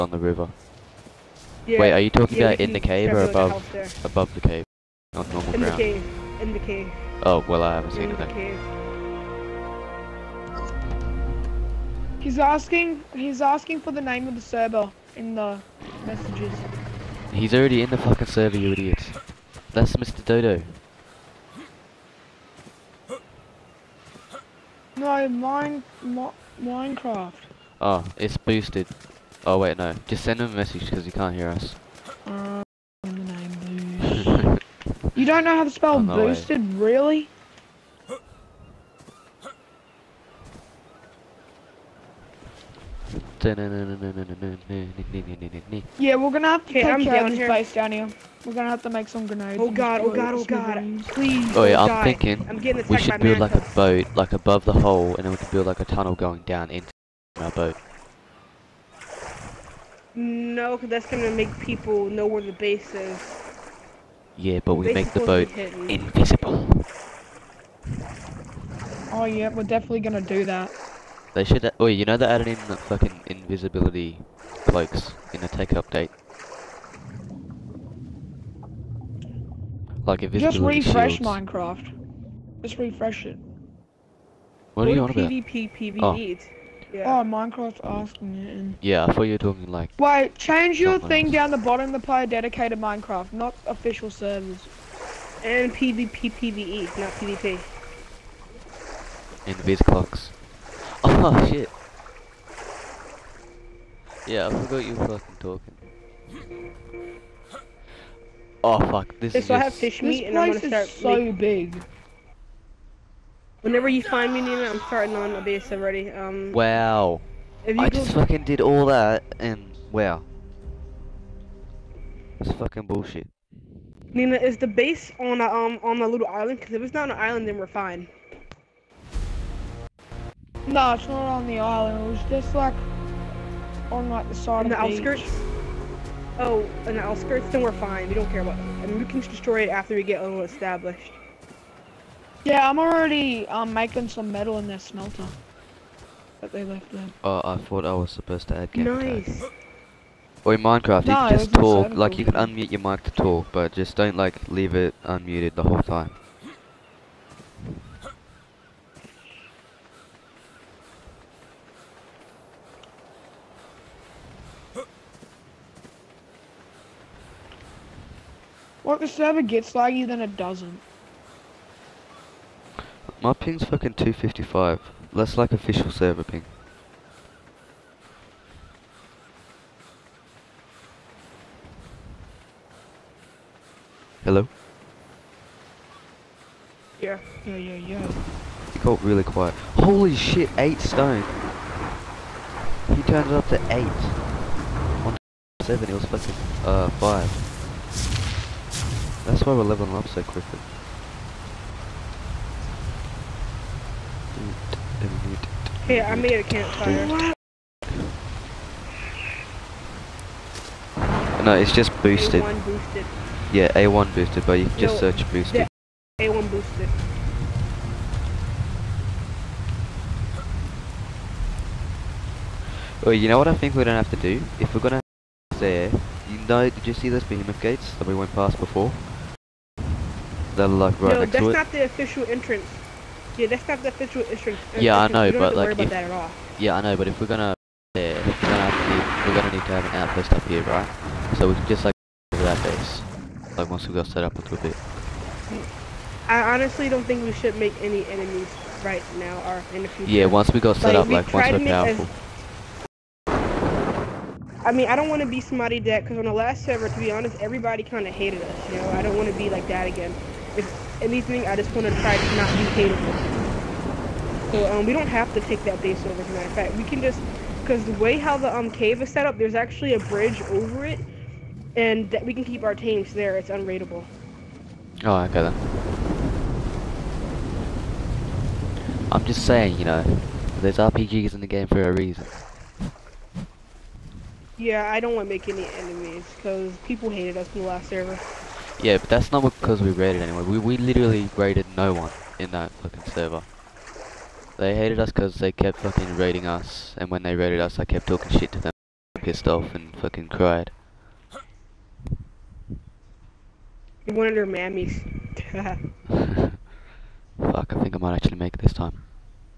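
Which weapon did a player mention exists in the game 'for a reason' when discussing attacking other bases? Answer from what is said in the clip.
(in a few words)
RPGs.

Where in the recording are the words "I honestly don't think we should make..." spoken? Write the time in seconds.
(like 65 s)
246 s.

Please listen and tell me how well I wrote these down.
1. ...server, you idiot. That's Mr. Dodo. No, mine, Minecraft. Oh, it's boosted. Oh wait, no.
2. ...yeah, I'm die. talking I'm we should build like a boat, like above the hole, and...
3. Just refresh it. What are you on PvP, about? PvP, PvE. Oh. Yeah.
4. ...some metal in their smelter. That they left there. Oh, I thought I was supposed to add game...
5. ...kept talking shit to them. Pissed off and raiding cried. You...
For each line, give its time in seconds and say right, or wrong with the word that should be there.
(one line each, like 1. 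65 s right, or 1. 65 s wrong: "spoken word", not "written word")
1. 18 s right
2. 51 s wrong: "thinking", not "talking"
3. 82 s right
4. 144 s right
5. 297 s wrong: "fucking", not "raiding".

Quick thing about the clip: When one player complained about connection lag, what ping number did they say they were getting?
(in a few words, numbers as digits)
255.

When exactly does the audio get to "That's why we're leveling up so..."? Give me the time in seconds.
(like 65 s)
199 s.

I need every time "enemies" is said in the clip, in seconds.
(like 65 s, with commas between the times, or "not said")
248 s, 285 s.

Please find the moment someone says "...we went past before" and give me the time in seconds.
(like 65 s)
228 s.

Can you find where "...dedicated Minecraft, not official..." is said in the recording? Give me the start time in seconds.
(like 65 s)
92 s.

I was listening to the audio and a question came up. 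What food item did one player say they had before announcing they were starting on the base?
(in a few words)
Fish meat.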